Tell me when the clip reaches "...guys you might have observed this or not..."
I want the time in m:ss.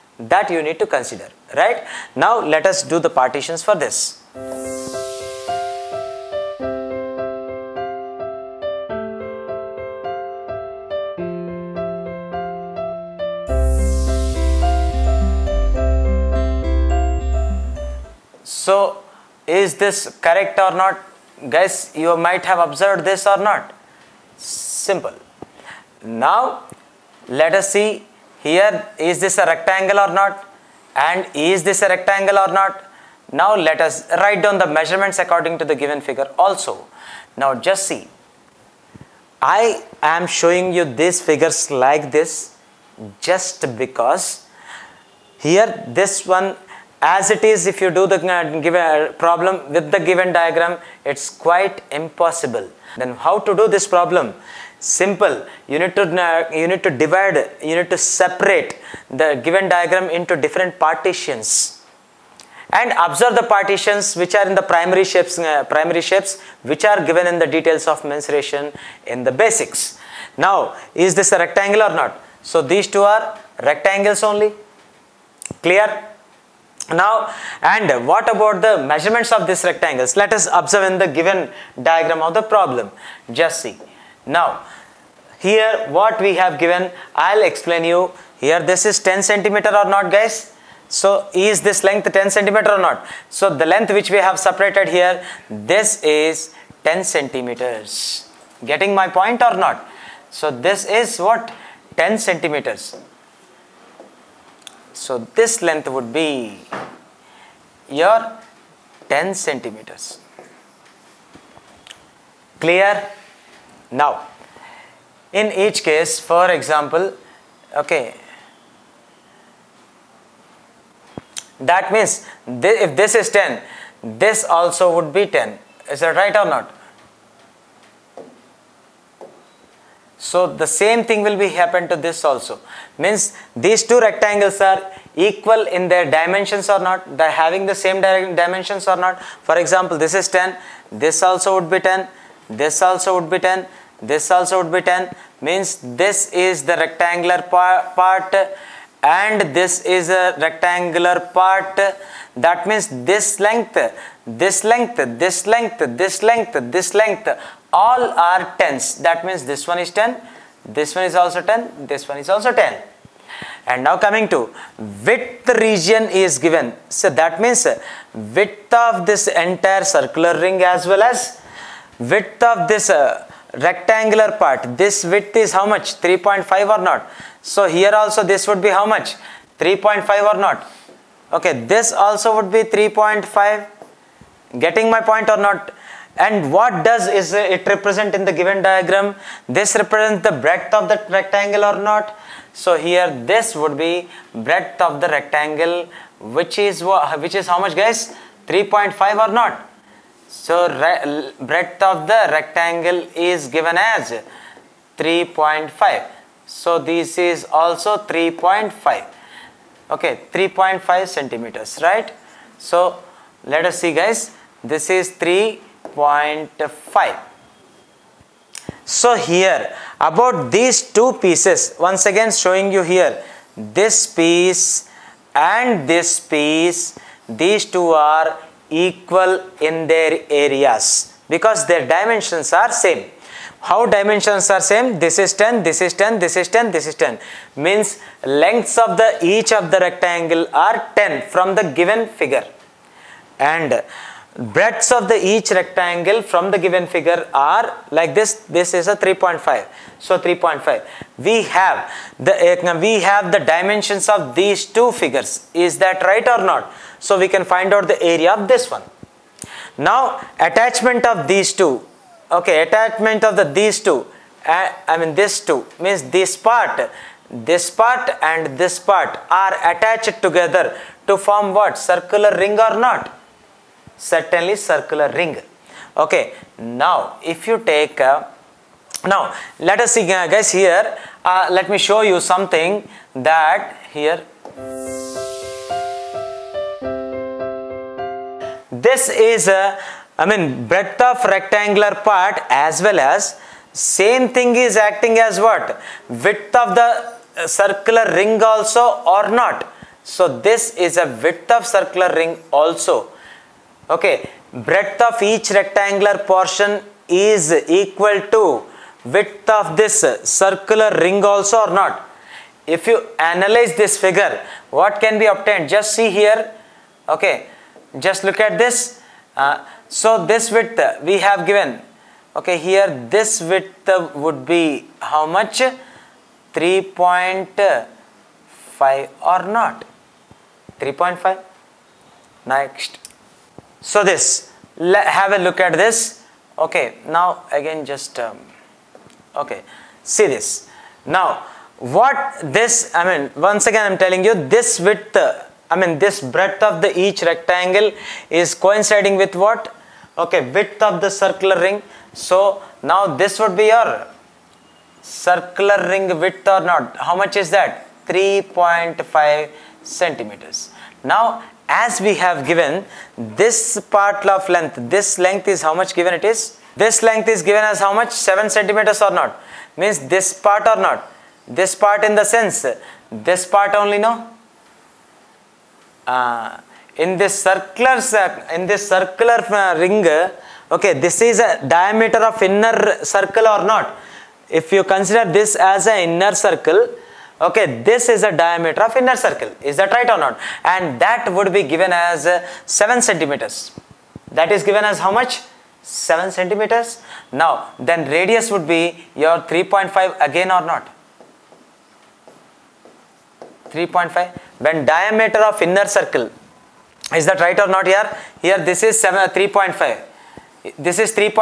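0:21.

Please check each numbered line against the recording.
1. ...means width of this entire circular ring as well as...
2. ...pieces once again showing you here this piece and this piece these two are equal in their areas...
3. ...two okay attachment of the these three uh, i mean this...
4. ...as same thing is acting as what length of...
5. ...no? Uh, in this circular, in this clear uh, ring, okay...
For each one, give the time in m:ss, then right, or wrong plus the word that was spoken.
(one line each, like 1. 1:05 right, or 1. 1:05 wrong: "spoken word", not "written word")
1. 2:47 right
2. 3:41 right
3. 4:21 wrong: "two", not "three"
4. 4:52 wrong: "width", not "length"
5. 6:13 wrong: "circular", not "clear".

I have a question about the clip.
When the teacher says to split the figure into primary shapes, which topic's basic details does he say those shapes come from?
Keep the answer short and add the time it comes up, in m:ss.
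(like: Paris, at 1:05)
Mensuration, at 1:08.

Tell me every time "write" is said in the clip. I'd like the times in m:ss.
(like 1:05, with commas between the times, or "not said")
0:34.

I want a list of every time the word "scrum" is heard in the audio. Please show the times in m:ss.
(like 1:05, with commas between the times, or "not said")
not said.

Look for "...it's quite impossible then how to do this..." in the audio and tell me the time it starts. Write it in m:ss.
0:51.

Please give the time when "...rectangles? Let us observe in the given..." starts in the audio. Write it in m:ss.
1:19.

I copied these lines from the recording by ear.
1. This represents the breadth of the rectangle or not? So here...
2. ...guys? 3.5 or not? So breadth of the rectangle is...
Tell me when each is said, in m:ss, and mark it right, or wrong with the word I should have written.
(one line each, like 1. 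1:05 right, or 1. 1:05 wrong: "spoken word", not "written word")
1. 3:09 right
2. 3:17 right.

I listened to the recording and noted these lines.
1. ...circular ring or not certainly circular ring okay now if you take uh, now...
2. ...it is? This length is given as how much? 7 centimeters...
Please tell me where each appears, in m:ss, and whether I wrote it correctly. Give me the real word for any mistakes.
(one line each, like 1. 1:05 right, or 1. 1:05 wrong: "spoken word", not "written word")
1. 4:31 right
2. 6:06 right.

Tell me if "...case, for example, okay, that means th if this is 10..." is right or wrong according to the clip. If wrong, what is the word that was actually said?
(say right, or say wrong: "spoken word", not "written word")
right.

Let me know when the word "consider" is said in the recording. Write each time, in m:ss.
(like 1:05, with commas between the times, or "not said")
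0:00, 6:24.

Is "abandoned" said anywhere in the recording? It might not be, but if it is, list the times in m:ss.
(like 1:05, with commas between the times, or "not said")
not said.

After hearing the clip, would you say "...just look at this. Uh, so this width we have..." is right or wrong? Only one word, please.
right.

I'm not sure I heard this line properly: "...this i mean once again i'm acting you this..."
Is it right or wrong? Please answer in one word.
wrong.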